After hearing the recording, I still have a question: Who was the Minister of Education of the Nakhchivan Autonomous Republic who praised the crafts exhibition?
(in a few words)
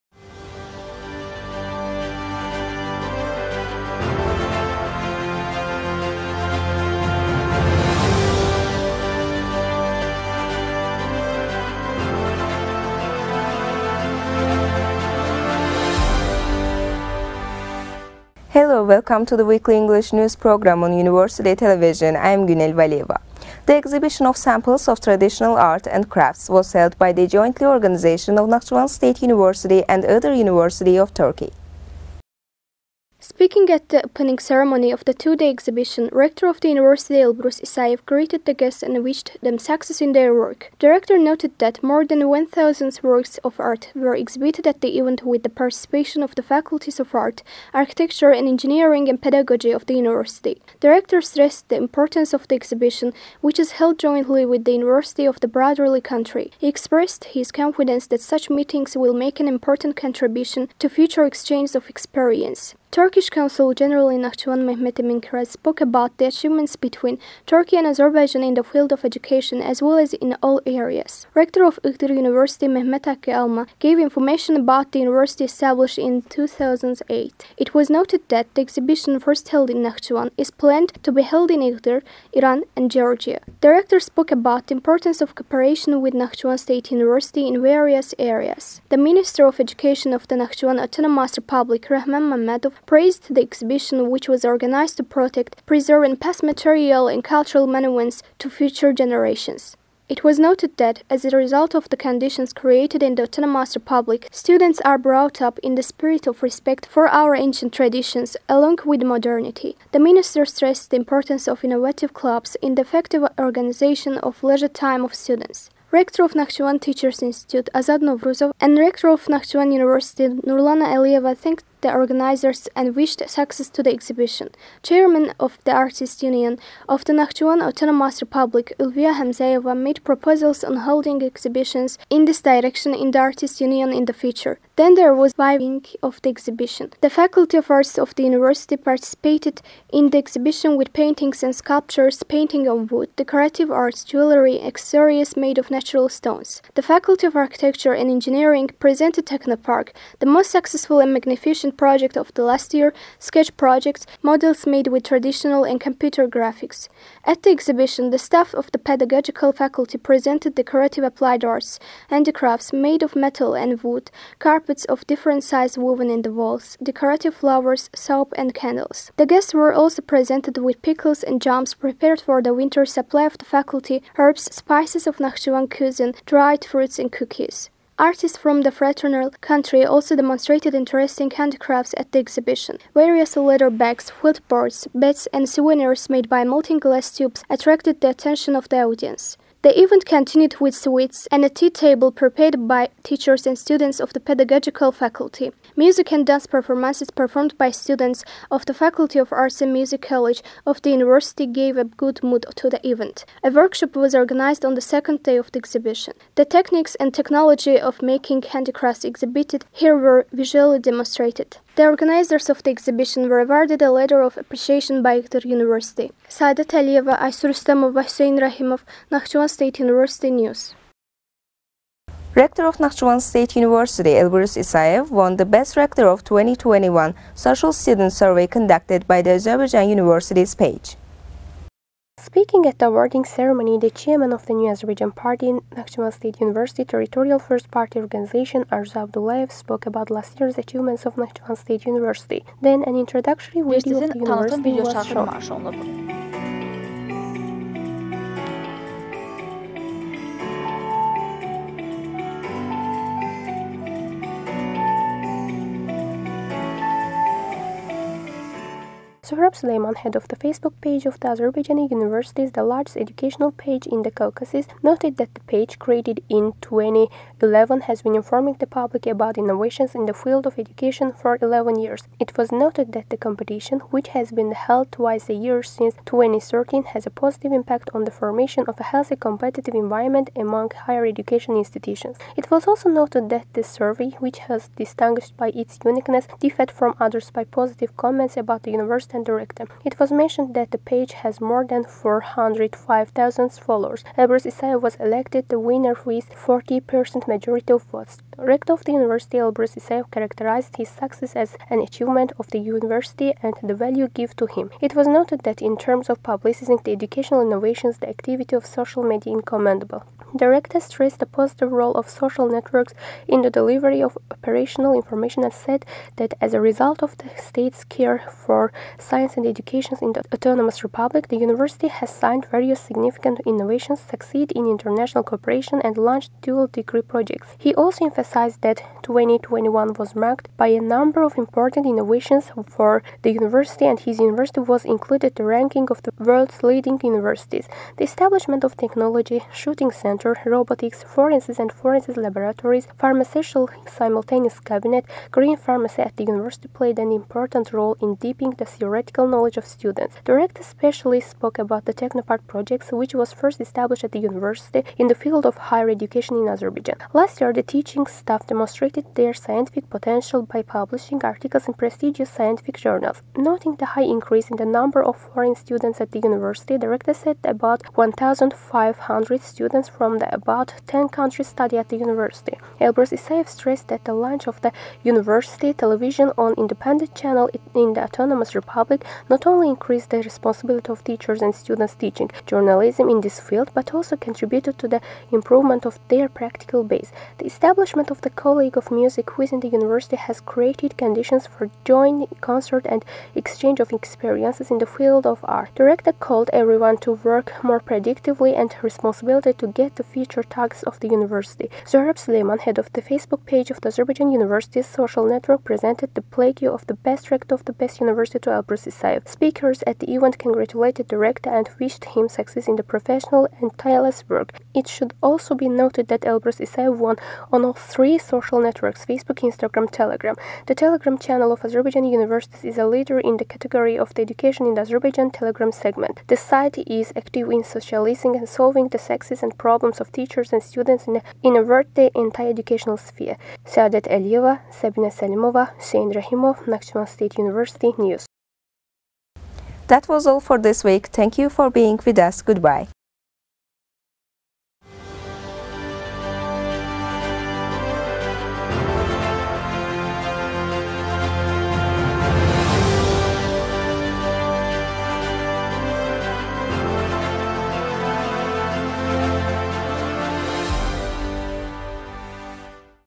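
Rahman Mamedov.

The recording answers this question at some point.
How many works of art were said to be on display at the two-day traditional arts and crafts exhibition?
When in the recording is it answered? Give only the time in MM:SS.
00:41.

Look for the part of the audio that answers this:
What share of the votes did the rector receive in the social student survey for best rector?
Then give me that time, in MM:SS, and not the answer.
04:56.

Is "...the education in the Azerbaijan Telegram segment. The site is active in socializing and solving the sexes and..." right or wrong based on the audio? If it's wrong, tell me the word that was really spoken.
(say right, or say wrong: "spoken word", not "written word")
right.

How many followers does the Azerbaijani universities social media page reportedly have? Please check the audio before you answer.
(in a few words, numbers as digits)
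more than 405,000.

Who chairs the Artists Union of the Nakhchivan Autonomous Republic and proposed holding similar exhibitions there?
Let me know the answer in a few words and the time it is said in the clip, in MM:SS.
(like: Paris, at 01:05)
Ulviya Hamzayeva, at 02:08.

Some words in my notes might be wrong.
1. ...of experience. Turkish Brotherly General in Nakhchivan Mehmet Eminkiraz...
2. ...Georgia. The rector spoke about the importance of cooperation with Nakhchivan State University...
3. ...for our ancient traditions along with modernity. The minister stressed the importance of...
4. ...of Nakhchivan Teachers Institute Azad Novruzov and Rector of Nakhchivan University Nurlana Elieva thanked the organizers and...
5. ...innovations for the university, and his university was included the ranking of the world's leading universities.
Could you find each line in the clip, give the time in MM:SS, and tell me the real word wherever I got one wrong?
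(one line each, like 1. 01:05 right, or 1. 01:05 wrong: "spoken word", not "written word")
1. 01:01 wrong: "Consul", not "Brotherly"
2. 01:22 right
3. 01:46 right
4. 01:56 right
5. 05:31 right.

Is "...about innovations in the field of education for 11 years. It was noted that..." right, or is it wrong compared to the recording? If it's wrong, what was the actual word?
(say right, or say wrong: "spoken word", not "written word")
right.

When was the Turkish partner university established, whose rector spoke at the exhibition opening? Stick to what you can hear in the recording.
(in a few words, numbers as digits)
2008.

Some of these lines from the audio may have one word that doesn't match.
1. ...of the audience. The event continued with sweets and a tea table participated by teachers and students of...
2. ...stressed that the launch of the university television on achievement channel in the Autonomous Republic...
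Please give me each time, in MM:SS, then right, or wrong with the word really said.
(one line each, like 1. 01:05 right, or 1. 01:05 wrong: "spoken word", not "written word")
1. 03:08 wrong: "prepared", not "participated"
2. 06:13 wrong: "independent", not "achievement".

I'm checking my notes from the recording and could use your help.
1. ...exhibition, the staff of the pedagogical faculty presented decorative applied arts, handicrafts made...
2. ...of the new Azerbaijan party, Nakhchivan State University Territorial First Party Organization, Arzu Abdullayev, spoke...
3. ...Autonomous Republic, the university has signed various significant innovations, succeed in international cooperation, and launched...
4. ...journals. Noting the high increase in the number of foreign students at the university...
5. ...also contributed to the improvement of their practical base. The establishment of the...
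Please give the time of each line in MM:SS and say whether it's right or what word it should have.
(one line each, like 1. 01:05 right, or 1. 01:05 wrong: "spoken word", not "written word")
1. 02:37 right
2. 03:54 right
3. 05:20 right
4. 06:02 right
5. 06:23 right.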